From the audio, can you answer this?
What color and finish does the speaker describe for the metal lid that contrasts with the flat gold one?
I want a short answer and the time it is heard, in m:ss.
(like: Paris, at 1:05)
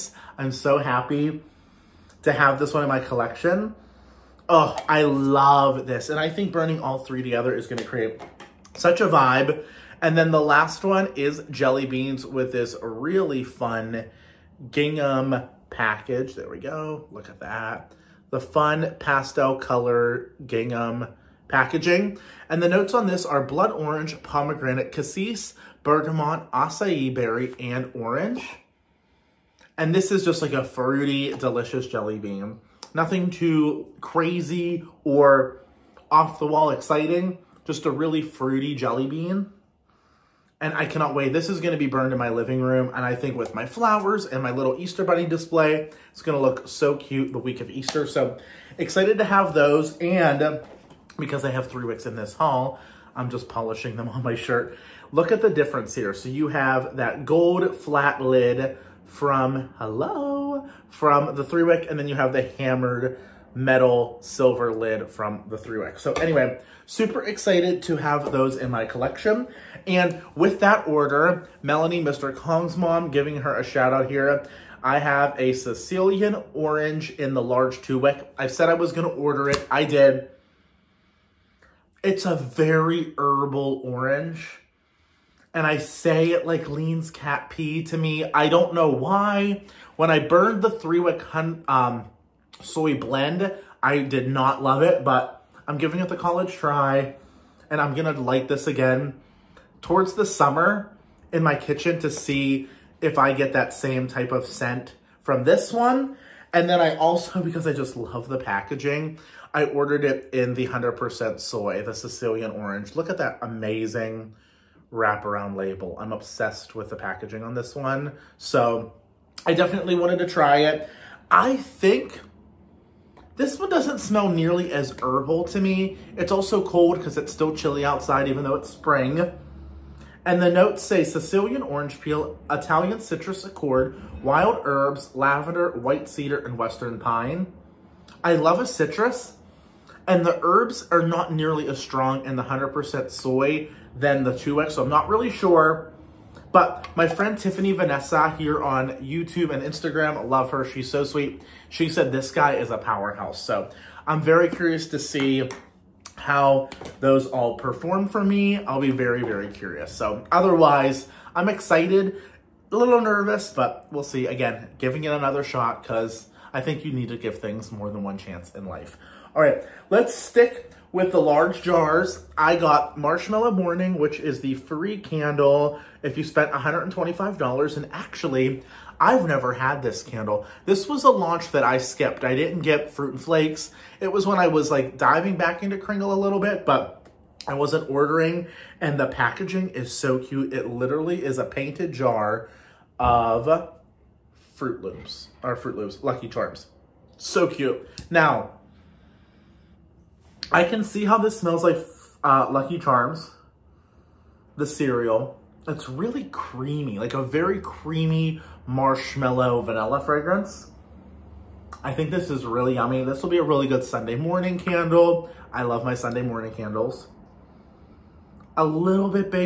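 Hammered metal silver, at 1:02.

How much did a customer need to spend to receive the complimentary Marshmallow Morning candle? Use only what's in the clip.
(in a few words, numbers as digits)
$125.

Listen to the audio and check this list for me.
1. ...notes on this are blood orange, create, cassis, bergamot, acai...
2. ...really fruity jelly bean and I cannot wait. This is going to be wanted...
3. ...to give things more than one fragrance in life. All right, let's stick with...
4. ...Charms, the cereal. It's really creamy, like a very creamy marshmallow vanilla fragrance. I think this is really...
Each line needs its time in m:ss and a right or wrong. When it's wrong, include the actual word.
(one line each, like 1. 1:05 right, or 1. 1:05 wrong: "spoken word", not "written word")
1. 0:22 wrong: "pomegranate", not "create"
2. 0:37 wrong: "burned", not "wanted"
3. 2:47 wrong: "chance", not "fragrance"
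4. 3:22 right.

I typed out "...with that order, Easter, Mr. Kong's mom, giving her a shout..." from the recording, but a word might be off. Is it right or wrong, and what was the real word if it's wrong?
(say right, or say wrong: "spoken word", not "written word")
wrong: "Melanie", not "Easter".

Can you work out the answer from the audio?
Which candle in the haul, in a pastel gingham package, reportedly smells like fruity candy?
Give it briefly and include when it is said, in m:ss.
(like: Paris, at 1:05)
Jelly beans, at 0:11.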